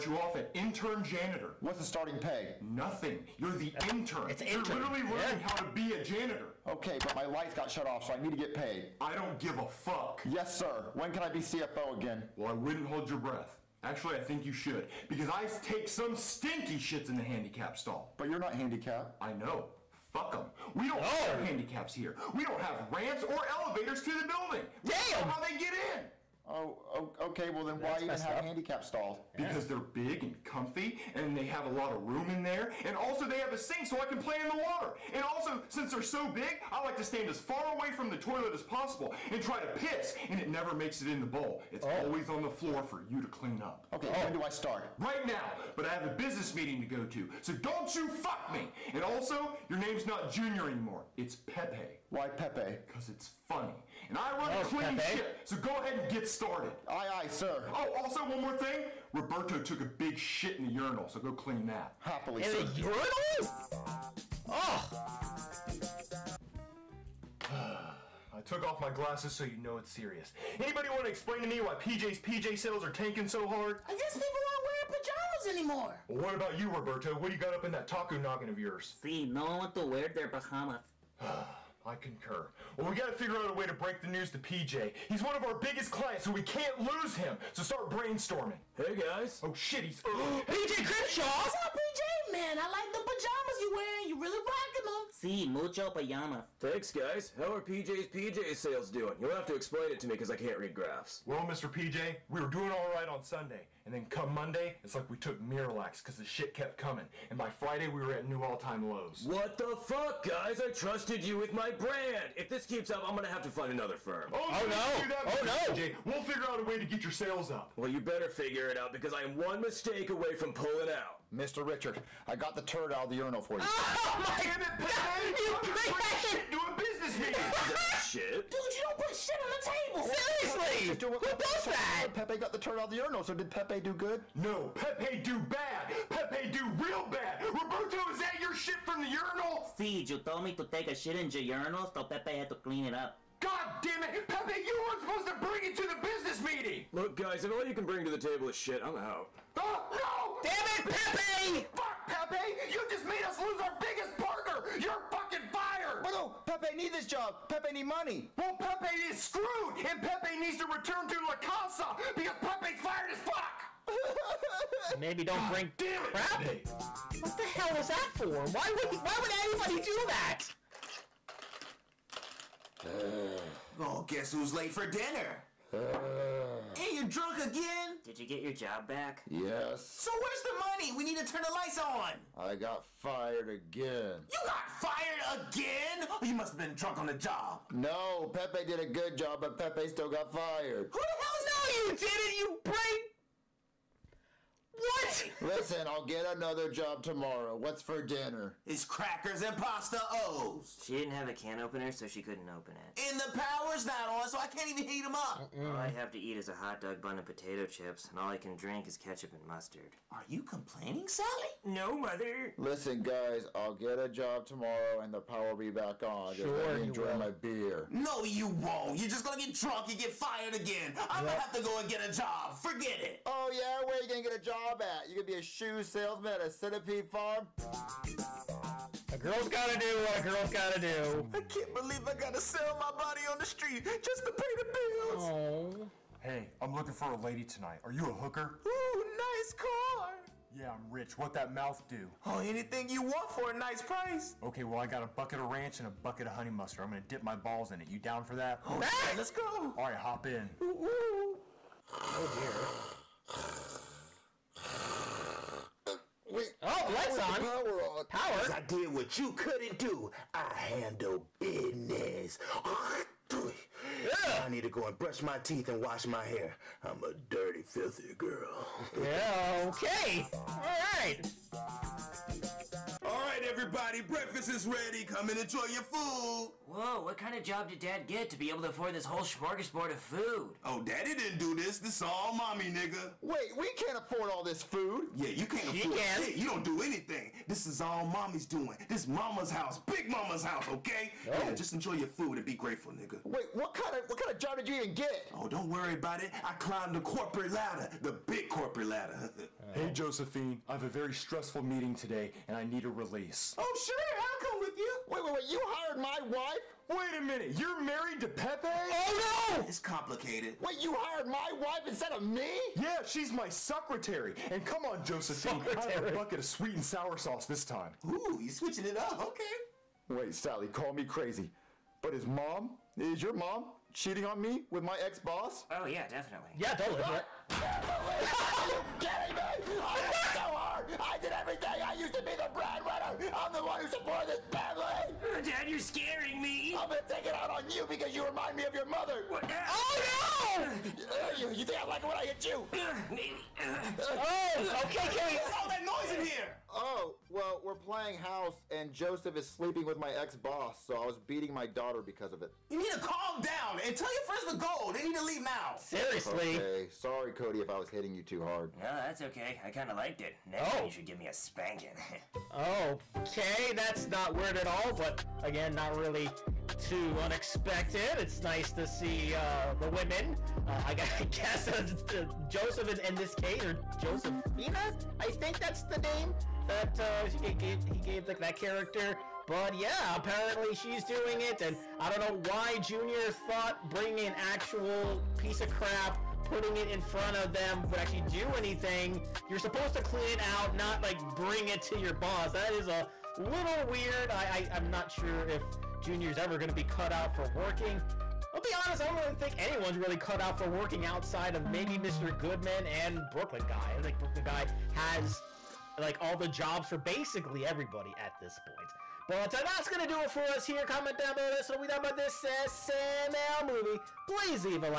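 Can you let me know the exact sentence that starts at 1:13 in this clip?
I guess people aren't wearing pajamas anymore.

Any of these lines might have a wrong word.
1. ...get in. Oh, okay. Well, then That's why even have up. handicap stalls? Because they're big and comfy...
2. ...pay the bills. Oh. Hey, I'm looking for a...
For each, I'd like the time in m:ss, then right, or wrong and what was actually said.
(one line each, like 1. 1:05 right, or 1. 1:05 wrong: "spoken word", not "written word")
1. 0:25 right
2. 3:54 right.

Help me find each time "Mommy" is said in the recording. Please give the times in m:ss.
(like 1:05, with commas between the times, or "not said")
4:42, 4:48.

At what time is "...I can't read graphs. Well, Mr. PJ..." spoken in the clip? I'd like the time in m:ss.
1:40.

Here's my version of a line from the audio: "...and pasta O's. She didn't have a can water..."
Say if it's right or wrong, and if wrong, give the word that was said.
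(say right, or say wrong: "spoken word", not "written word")
wrong: "opener", not "water".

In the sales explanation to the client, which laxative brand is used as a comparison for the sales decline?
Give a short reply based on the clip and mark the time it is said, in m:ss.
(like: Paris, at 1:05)
Miralax, at 1:45.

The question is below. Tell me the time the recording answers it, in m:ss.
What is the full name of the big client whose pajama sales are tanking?
1:30.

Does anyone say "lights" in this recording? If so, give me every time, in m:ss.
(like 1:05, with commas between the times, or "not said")
0:07, 3:01, 4:16.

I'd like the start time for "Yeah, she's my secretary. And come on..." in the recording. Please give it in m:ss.
5:12.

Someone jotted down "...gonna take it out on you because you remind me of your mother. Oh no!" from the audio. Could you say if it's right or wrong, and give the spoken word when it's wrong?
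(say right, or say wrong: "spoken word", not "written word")
right.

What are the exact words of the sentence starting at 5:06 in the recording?
Wait a minute, you're married to Pepe?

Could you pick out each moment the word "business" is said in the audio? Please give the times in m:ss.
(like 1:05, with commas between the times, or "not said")
0:46, 2:06, 2:26, 4:21.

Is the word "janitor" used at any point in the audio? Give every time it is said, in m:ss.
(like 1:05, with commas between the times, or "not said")
0:01, 0:06.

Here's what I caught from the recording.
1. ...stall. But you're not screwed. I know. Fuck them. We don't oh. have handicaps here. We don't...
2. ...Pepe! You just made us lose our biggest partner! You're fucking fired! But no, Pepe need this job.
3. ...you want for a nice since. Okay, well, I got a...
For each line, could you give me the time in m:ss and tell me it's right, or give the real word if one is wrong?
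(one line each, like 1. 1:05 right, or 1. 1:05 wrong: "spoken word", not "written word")
1. 0:17 wrong: "handicapped", not "screwed"
2. 2:32 right
3. 4:02 wrong: "price", not "since".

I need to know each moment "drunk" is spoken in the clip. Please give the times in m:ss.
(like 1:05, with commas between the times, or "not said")
2:57, 3:06, 3:39.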